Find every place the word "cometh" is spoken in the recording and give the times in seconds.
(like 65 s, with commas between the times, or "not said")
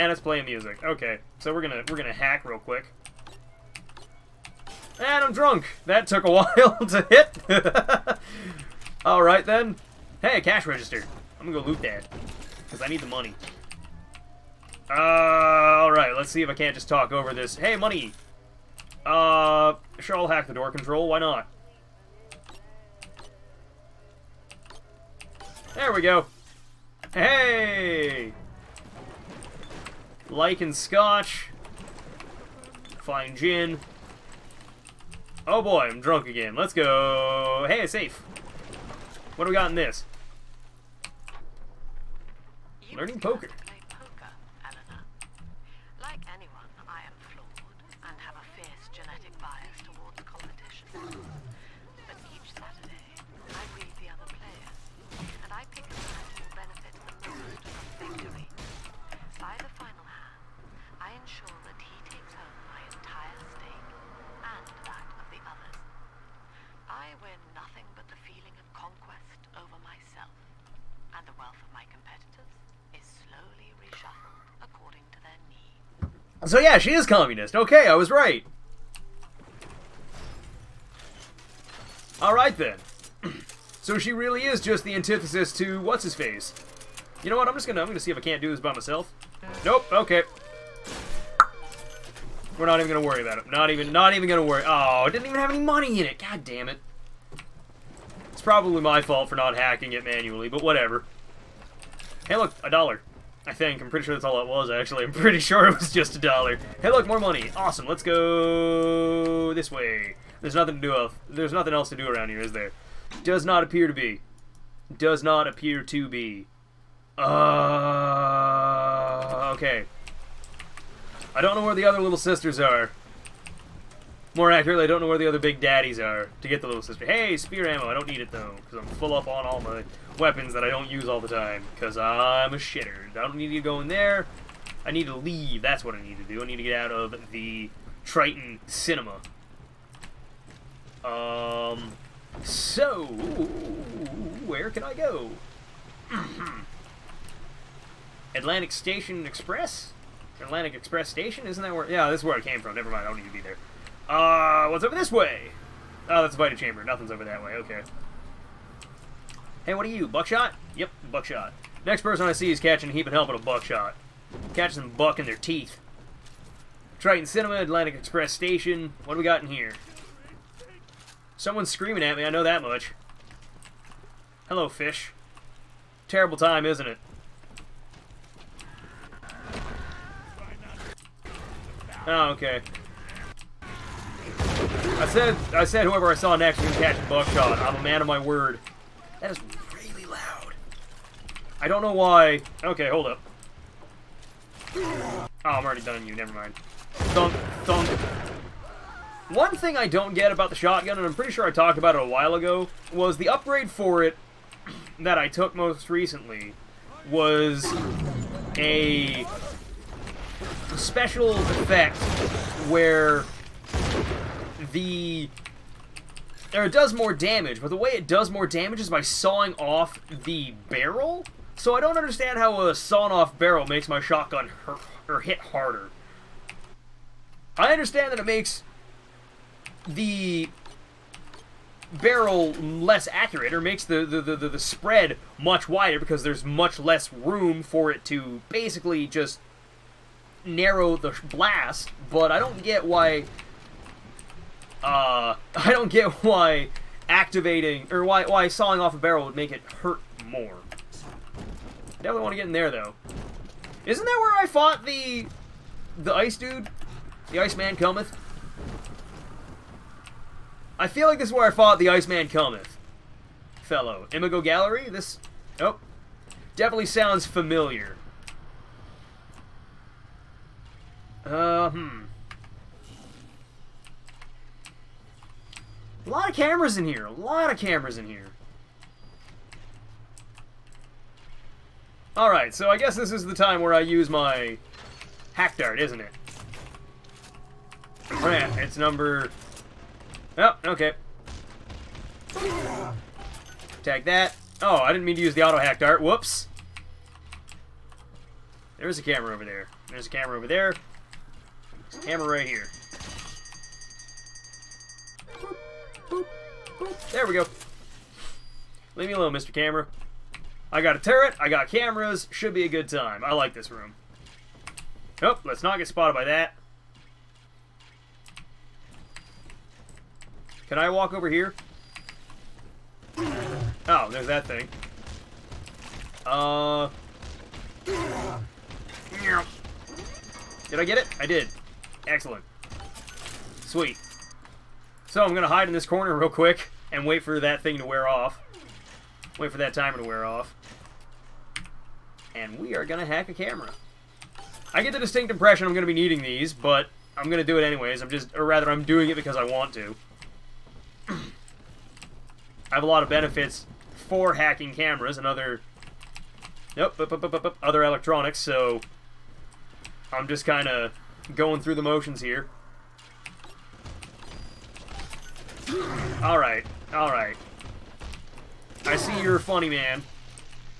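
257 s, 262 s.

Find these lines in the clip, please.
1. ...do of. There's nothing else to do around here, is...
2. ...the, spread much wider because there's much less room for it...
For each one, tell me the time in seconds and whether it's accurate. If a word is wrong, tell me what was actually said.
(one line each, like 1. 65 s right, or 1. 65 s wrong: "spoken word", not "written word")
1. 110 s right
2. 234 s right.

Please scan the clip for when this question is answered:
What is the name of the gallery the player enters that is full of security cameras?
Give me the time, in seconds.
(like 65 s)
264 s.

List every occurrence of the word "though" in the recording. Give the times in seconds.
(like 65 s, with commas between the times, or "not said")
128 s, 252 s.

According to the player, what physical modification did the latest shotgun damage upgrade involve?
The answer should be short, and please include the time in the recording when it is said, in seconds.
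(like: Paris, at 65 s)
Sawing off the barrel, at 219 s.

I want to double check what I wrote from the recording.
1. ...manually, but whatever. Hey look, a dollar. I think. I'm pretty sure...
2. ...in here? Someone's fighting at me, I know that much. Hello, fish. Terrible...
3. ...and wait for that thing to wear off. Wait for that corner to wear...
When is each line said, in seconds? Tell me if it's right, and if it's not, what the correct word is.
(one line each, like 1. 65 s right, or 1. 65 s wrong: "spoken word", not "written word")
1. 100 s right
2. 169 s wrong: "screaming", not "fighting"
3. 336 s wrong: "timer", not "corner".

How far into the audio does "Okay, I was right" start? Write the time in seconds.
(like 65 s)
77 s.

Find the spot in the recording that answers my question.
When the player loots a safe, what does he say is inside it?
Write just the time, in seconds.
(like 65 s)
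42 s.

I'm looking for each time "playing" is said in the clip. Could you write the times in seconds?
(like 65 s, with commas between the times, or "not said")
0 s.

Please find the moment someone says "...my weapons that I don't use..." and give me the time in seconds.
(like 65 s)
129 s.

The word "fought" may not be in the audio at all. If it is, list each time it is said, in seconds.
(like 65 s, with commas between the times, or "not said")
254 s, 261 s.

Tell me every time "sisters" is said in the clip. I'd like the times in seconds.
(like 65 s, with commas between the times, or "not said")
122 s, 126 s.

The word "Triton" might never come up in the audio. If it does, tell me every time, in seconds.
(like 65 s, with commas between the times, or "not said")
138 s, 166 s.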